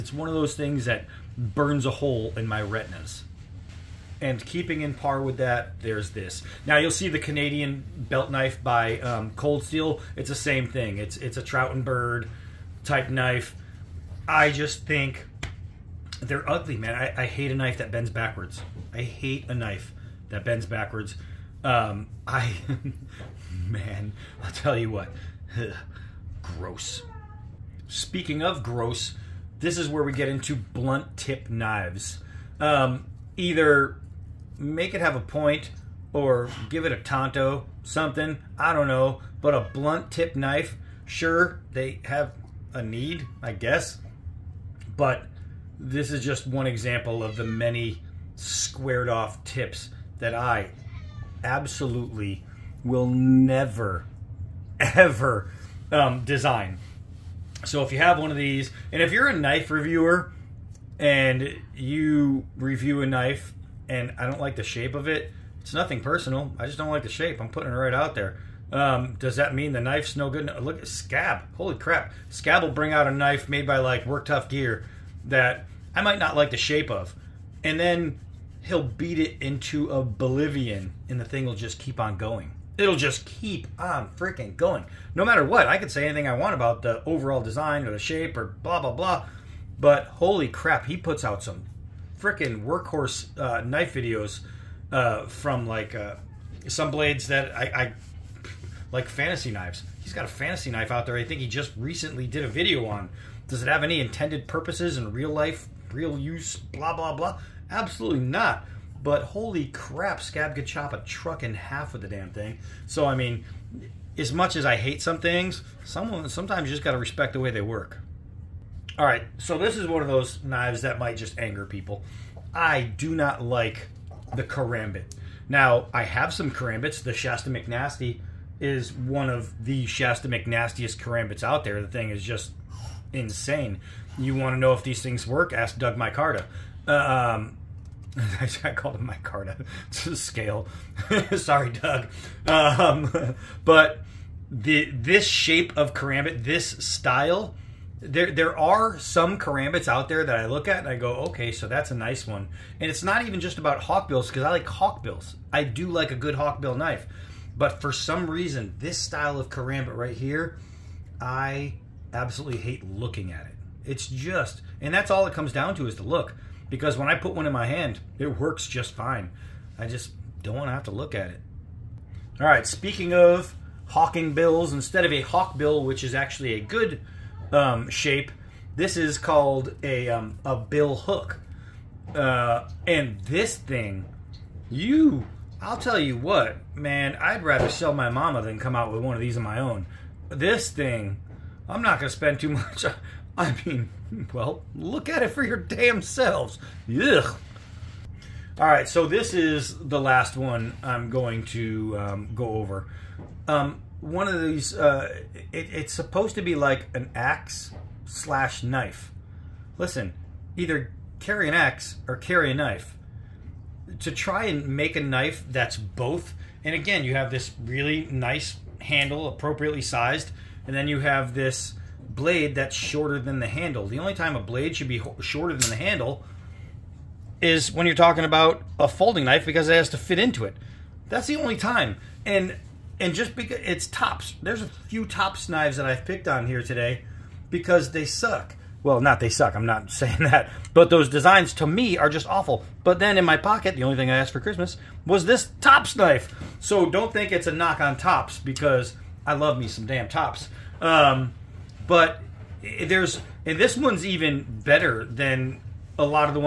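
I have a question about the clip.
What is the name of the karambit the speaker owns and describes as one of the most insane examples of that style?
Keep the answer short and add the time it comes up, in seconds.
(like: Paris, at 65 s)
Shasta McNasty, at 127 s.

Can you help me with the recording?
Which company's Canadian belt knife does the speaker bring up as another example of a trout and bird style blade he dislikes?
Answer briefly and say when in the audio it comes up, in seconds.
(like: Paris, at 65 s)
Cold Steel, at 9 s.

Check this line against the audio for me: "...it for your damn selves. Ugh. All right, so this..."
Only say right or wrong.
right.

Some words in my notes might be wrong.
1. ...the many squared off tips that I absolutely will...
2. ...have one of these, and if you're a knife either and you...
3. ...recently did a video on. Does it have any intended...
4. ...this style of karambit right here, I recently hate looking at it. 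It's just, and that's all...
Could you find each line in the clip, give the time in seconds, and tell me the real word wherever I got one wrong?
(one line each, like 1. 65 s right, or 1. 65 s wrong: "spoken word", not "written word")
1. 47 s right
2. 57 s wrong: "reviewer", not "either"
3. 101 s right
4. 158 s wrong: "absolutely", not "recently".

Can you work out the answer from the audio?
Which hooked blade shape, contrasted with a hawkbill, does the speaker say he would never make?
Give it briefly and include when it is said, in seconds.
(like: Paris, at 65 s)
bill hook, at 180 s.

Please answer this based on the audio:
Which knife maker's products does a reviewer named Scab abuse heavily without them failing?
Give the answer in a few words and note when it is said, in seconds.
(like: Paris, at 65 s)
Work Tuff Gear, at 74 s.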